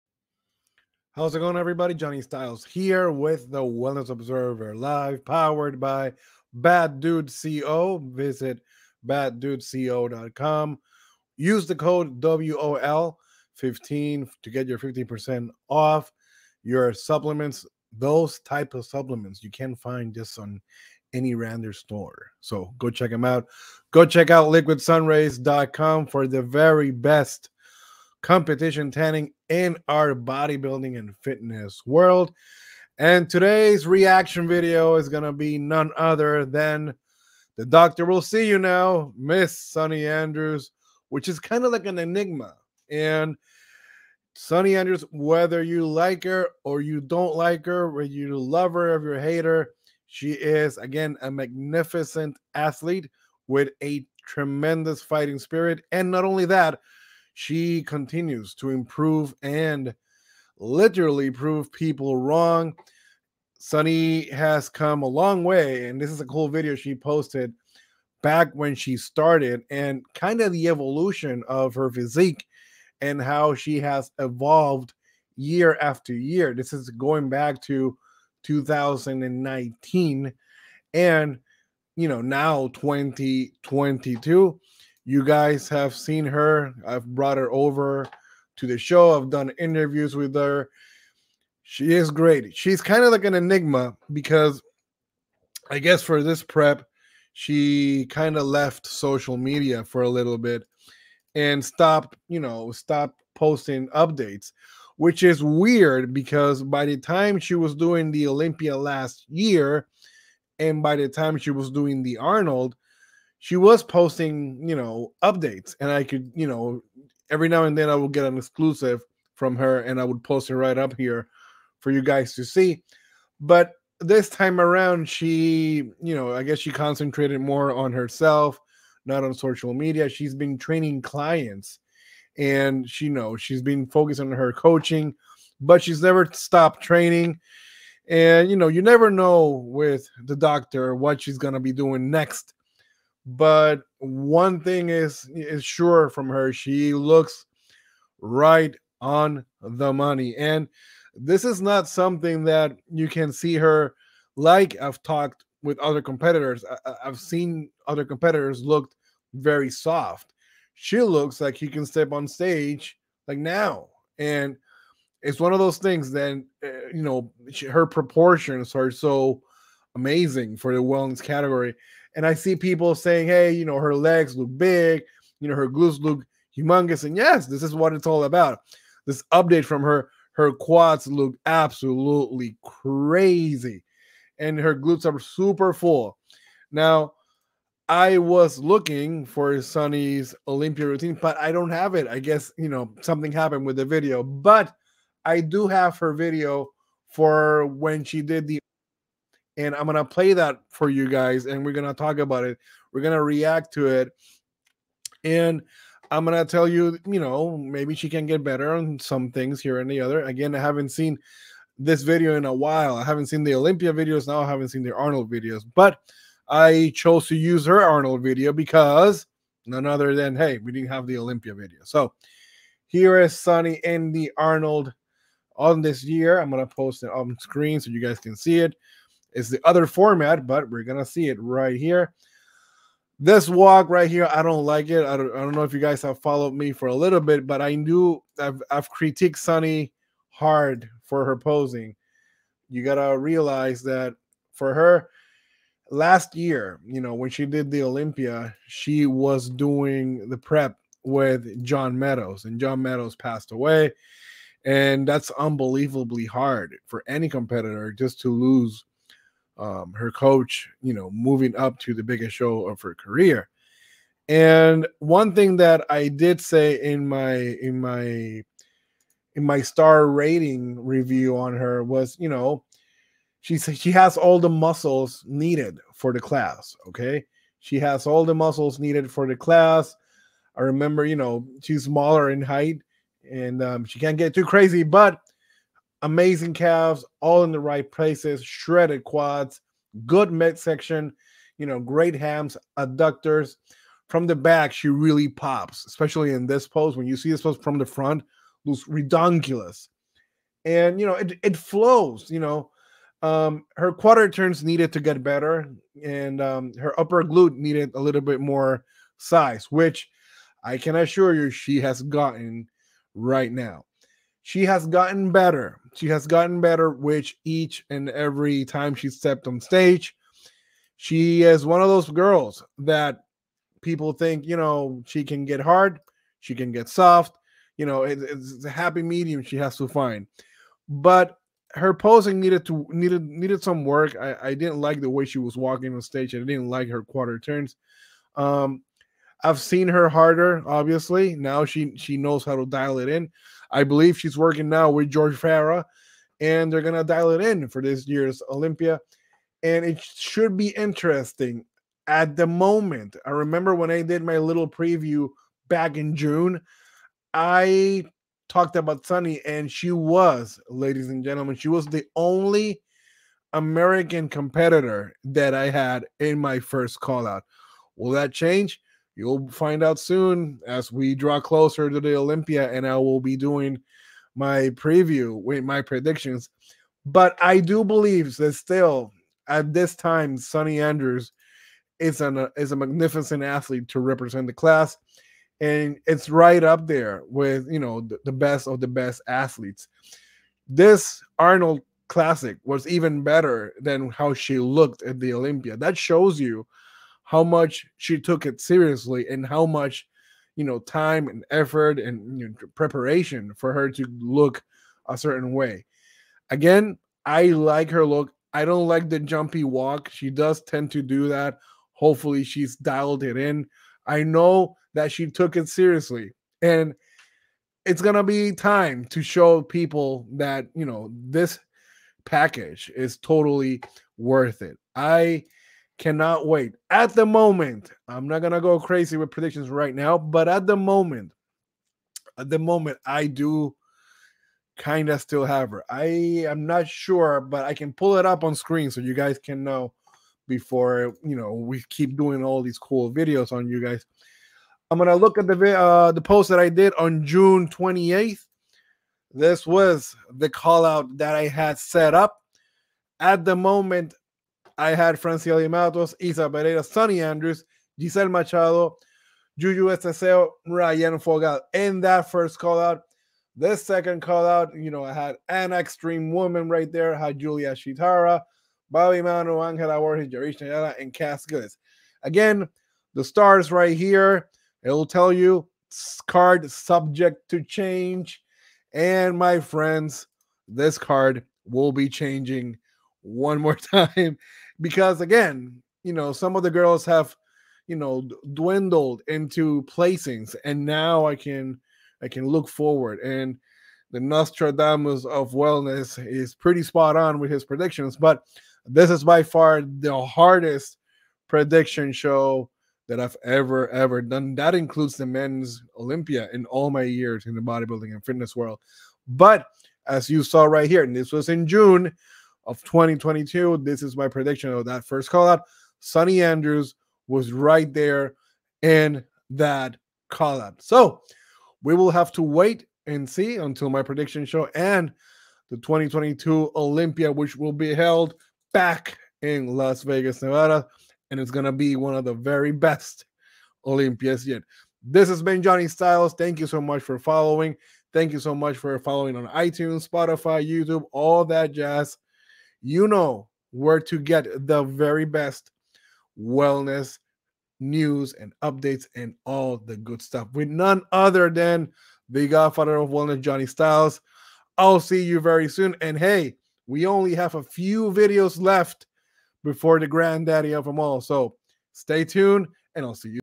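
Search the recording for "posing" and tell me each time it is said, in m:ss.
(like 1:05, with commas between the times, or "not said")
4:01, 5:31.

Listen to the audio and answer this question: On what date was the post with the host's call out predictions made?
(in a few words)
June 28th.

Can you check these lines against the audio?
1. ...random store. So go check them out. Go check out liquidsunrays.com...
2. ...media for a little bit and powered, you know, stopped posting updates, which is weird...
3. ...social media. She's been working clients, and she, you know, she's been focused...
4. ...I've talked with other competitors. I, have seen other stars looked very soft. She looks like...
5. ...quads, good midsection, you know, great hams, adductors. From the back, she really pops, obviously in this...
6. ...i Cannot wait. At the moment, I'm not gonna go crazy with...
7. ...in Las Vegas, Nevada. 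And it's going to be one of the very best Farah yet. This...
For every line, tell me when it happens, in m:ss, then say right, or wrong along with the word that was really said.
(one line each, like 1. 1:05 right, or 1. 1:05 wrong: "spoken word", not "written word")
1. 0:21 right
2. 1:39 wrong: "stopped", not "powered"
3. 2:09 wrong: "training", not "working"
4. 2:34 wrong: "competitors", not "stars"
5. 4:49 wrong: "especially", not "obviously"
6. 7:04 right
7. 8:49 wrong: "Olympias", not "Farah".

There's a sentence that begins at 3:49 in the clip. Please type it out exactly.
It's the other format, but we're gonna see it right here.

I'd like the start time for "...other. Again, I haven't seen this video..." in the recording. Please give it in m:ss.
3:30.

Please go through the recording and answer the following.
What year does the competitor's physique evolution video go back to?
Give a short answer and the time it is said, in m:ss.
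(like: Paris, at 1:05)
2019, at 1:18.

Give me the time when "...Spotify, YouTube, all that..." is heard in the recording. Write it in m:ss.
9:00.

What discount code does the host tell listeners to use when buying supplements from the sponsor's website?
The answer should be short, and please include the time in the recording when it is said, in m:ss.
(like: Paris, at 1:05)
WOL15, at 0:12.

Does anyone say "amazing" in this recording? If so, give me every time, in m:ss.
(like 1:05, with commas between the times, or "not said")
2:49, 4:46.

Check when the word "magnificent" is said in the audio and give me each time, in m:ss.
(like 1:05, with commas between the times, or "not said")
0:51, 6:22.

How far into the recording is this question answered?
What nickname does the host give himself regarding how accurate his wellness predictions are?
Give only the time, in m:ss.
8:14.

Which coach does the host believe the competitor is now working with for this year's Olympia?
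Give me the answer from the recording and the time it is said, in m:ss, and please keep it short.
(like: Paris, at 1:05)
George Farah, at 5:45.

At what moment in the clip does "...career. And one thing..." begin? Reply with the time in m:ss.
4:22.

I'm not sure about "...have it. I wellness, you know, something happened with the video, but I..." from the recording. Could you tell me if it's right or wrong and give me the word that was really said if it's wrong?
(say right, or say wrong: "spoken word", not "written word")
wrong: "guess", not "wellness".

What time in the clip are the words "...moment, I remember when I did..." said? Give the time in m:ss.
5:52.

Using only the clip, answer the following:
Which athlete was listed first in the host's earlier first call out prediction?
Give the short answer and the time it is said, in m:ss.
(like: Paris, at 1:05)
Francielle Mattos, at 7:35.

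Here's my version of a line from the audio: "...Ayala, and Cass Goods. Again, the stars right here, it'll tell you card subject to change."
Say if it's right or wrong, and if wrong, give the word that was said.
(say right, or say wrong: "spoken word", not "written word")
right.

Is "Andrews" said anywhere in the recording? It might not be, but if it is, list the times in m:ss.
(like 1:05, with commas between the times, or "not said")
0:40, 0:44, 6:20, 7:37, 8:36.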